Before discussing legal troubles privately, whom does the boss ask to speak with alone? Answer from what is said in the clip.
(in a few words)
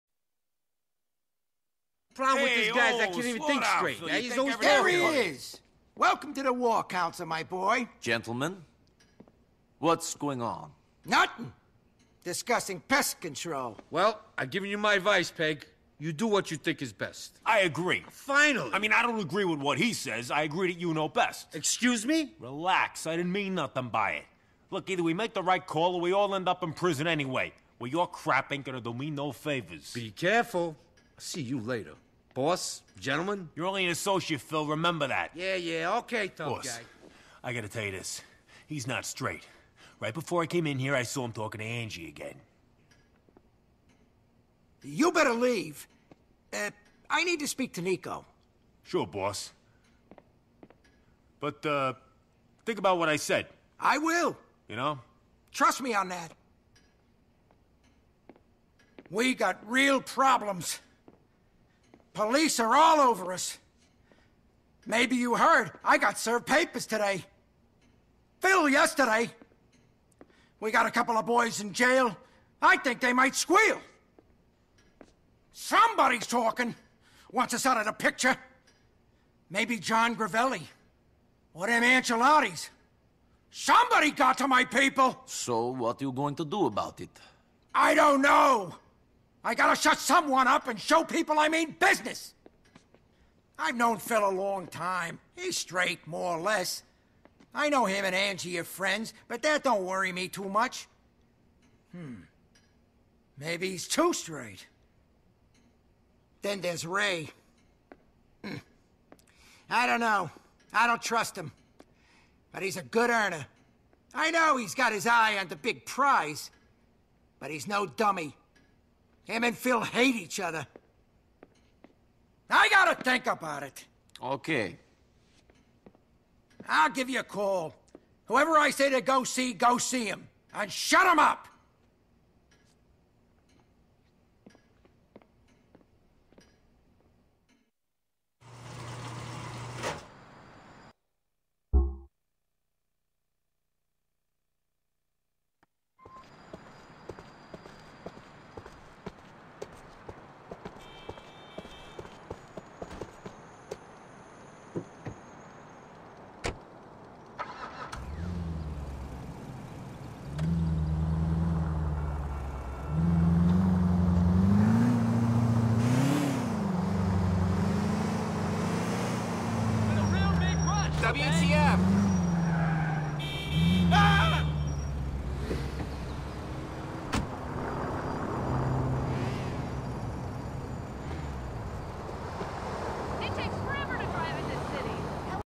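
Niko.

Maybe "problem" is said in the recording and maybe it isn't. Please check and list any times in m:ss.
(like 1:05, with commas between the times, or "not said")
0:02, 1:00.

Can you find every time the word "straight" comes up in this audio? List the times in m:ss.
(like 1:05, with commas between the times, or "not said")
0:03, 0:39, 1:35, 1:44.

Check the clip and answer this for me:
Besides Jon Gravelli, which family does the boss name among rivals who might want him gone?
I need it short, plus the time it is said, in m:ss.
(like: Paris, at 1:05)
Ancelotti's, at 1:21.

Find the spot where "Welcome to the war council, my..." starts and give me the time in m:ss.
0:05.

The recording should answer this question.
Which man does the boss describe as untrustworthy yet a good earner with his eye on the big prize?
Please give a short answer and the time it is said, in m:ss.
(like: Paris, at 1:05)
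Ray, at 1:46.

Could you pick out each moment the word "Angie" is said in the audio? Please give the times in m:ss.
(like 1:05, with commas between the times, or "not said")
0:41, 1:38.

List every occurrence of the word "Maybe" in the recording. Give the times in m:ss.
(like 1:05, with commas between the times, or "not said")
1:04, 1:19, 1:43.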